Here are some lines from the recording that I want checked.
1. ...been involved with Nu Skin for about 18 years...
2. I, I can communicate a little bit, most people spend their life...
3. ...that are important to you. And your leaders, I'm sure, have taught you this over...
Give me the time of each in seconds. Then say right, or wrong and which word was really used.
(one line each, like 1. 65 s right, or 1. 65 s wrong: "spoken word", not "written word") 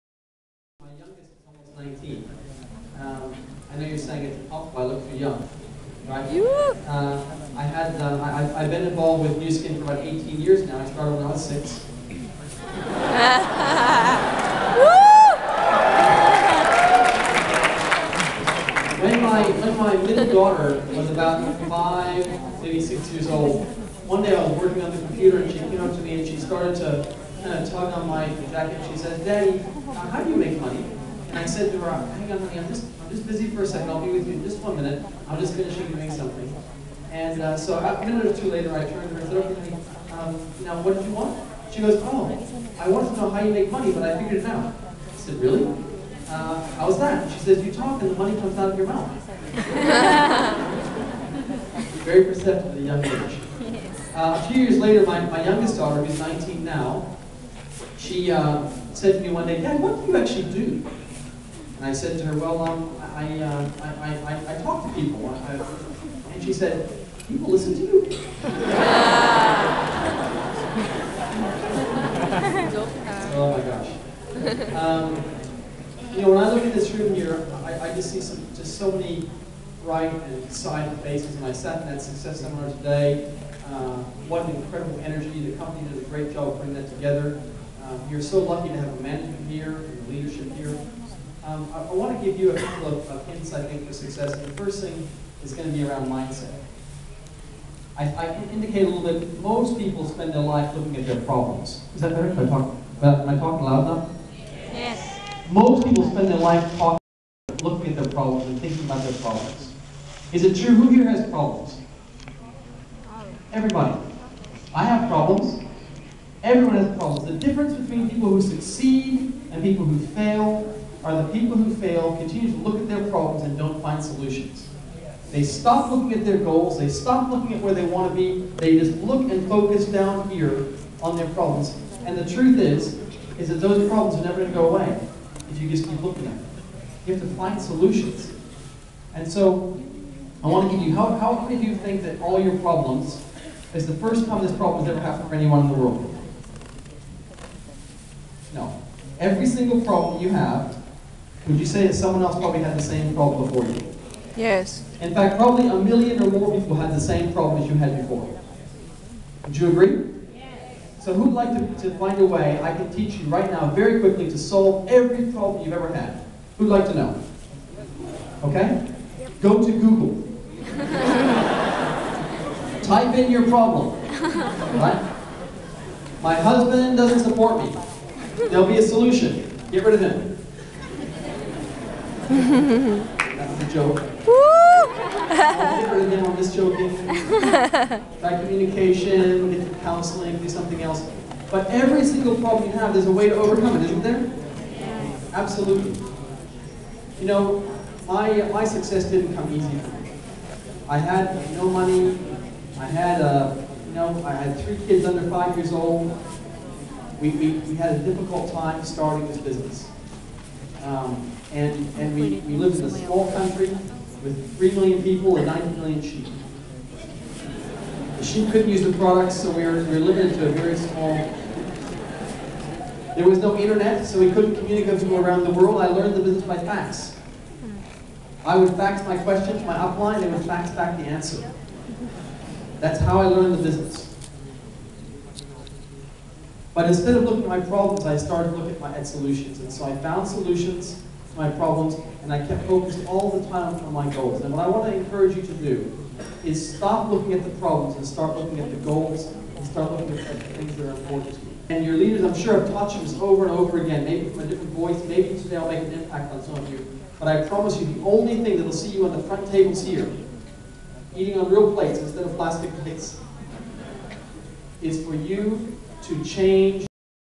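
1. 8 s right
2. 97 s wrong: "indicate", not "communicate"
3. 250 s right.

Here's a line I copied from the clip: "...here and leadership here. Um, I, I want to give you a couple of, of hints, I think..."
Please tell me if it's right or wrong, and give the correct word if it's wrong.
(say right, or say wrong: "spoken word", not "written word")
right.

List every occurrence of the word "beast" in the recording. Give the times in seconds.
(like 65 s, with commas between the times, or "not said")
not said.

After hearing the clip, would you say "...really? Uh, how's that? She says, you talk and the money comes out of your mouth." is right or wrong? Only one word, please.
right.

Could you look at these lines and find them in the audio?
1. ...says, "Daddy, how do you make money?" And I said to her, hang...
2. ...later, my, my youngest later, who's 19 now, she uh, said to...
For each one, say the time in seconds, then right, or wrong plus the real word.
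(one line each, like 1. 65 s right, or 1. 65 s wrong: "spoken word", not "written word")
1. 28 s right
2. 54 s wrong: "daughter", not "later".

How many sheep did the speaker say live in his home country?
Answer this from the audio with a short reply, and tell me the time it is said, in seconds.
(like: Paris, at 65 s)
90 million, at 215 s.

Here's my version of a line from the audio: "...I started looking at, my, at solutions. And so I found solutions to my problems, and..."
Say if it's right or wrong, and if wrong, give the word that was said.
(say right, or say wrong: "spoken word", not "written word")
right.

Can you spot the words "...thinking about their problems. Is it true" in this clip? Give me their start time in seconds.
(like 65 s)
108 s.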